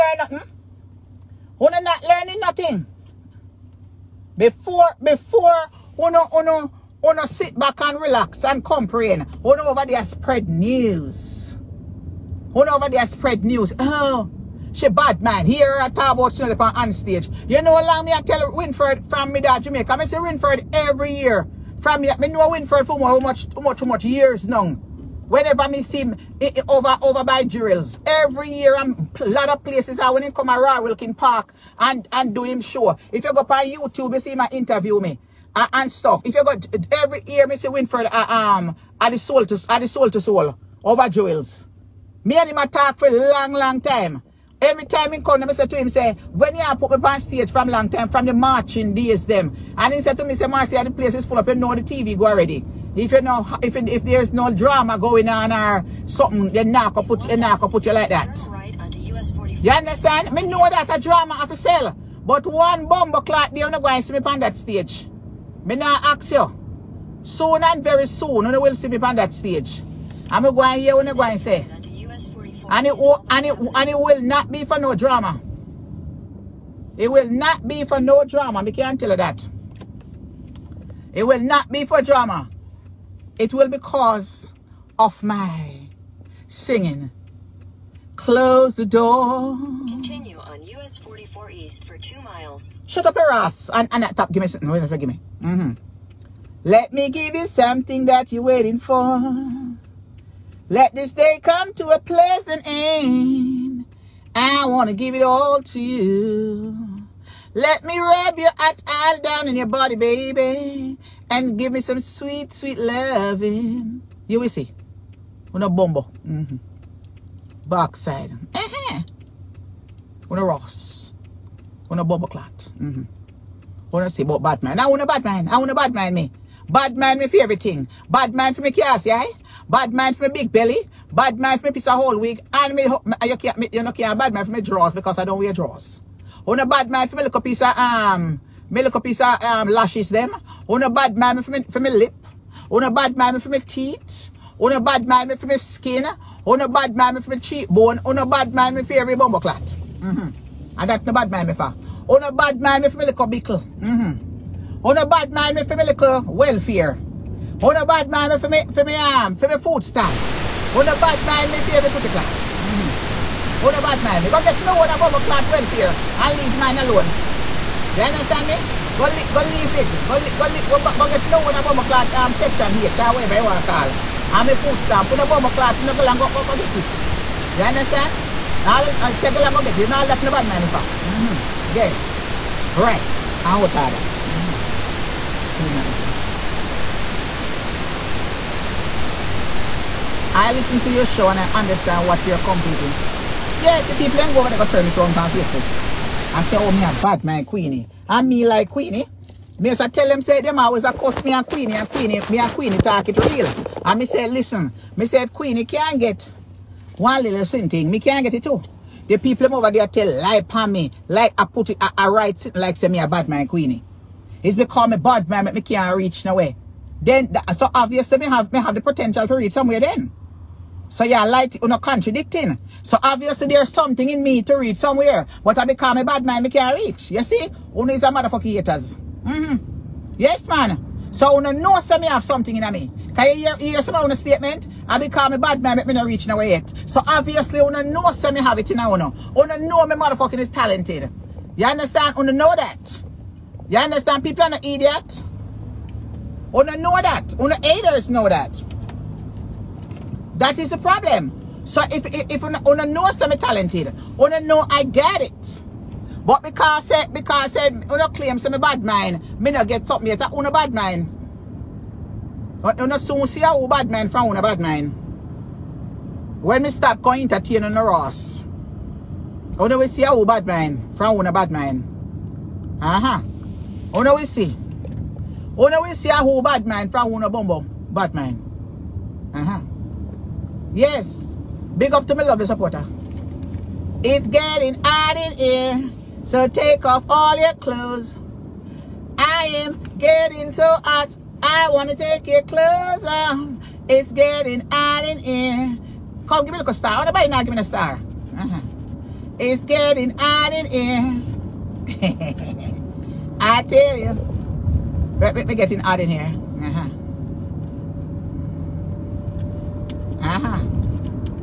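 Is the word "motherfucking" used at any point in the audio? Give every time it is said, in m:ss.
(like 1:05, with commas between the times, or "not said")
3:48, 3:59.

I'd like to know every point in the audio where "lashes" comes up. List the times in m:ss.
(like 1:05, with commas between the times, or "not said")
2:19.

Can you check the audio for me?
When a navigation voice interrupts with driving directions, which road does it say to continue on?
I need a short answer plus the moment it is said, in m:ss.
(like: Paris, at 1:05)
US 44 East, at 1:30.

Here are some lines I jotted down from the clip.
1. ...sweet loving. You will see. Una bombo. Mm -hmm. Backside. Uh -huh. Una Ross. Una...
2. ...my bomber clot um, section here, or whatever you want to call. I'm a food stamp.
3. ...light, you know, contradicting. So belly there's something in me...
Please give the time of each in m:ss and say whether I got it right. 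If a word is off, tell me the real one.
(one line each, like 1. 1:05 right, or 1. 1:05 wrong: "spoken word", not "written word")
1. 1:52 right
2. 2:51 right
3. 3:41 wrong: "obviously", not "belly".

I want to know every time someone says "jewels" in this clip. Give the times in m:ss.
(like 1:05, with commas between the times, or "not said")
0:27, 0:41.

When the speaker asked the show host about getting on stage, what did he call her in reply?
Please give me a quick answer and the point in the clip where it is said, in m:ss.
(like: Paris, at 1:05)
Marcy, at 0:50.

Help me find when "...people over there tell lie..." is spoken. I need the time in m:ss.
3:29.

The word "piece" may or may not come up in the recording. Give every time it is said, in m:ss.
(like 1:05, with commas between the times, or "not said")
2:11, 2:17.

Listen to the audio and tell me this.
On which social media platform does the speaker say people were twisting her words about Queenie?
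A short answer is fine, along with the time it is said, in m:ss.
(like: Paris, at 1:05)
Facebook, at 3:15.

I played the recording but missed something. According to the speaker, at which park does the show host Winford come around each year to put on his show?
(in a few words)
Wilkin Park.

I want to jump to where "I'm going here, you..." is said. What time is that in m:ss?
1:10.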